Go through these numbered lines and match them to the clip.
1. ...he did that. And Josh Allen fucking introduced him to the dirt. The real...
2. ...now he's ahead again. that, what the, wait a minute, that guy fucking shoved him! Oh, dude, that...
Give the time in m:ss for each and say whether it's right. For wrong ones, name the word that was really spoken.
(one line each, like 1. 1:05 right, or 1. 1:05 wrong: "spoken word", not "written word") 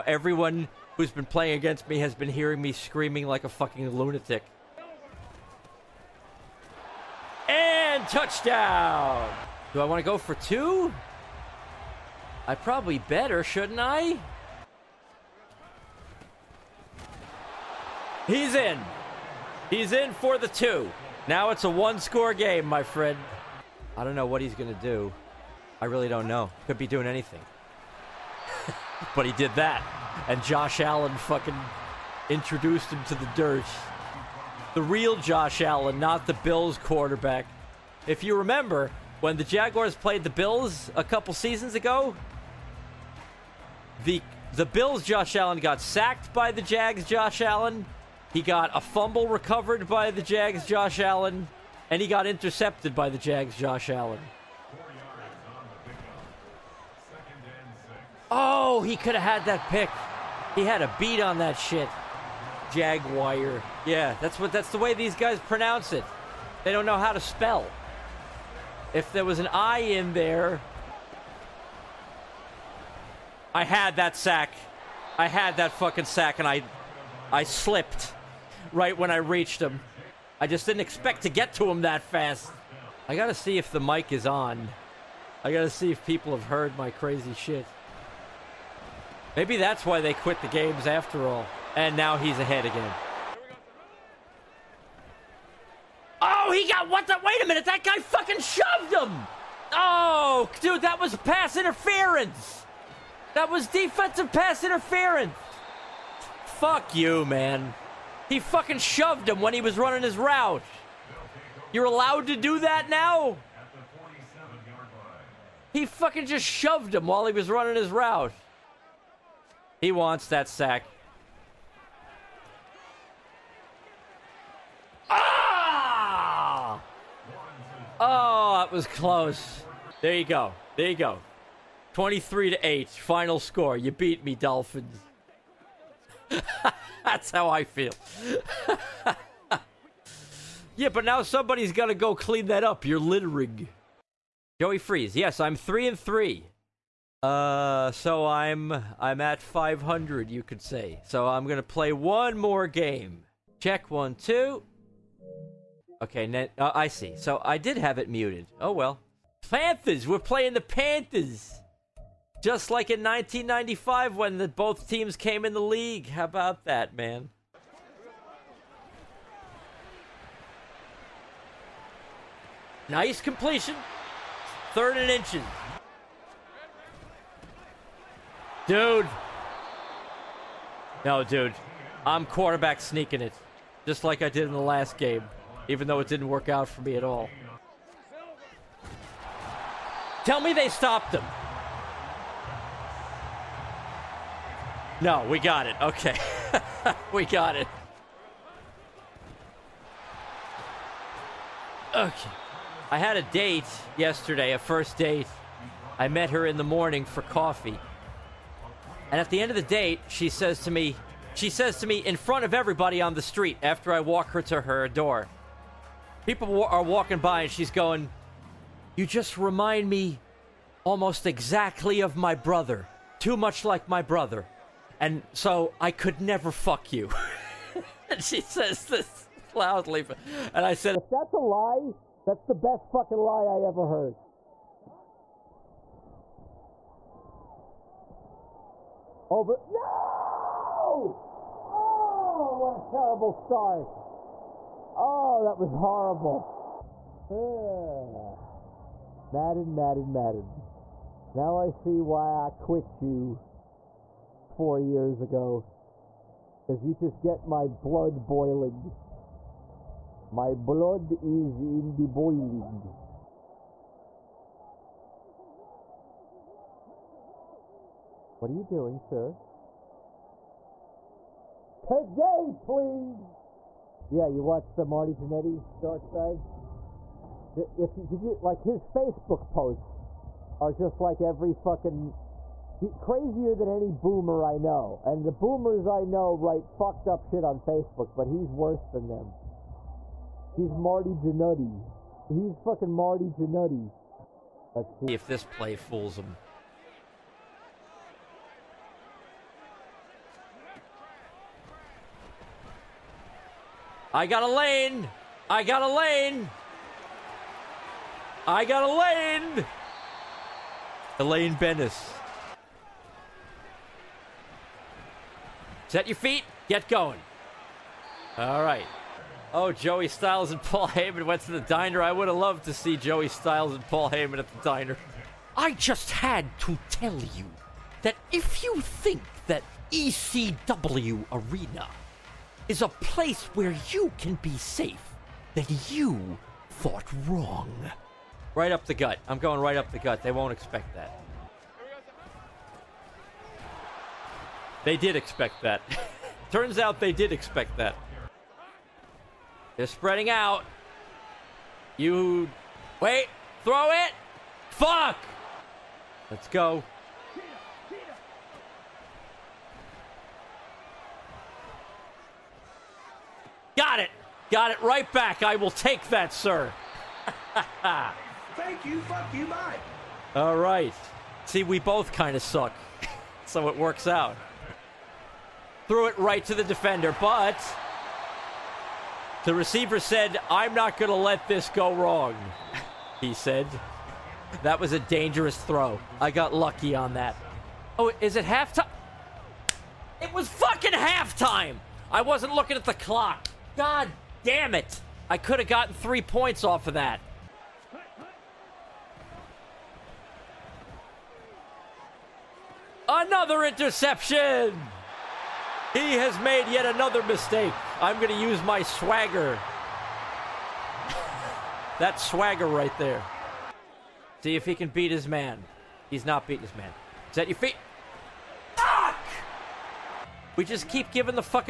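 1. 0:29 right
2. 1:31 right.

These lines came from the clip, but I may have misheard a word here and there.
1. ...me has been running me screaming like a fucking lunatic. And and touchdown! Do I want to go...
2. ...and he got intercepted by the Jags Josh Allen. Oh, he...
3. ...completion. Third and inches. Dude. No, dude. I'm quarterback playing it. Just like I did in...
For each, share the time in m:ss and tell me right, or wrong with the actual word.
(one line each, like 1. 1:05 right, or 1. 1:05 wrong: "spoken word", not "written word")
1. 0:01 wrong: "hearing", not "running"
2. 0:51 right
3. 2:53 wrong: "sneaking", not "playing".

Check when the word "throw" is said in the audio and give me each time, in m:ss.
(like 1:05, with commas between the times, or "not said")
5:53, 6:25.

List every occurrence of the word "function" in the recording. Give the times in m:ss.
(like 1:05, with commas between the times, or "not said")
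not said.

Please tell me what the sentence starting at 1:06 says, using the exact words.
They don't know how to spell.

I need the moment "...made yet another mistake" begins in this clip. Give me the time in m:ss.
6:46.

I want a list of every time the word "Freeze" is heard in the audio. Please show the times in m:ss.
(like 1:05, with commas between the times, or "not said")
2:24.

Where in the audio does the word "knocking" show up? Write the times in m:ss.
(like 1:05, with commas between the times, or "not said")
not said.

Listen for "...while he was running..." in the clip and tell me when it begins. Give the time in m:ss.
1:57.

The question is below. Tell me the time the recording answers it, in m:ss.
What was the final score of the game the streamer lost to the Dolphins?
2:11.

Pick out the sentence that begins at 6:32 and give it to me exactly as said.
I wasn't looking at the clock.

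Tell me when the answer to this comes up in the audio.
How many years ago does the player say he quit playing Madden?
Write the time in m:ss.
4:14.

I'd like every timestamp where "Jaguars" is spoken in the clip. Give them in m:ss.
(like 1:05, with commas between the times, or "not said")
0:39, 1:02.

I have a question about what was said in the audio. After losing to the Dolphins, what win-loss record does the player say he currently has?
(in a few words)
3 and 3.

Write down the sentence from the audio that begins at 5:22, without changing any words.
I would have loved to see Joey Styles and Paul Heyman at the diner.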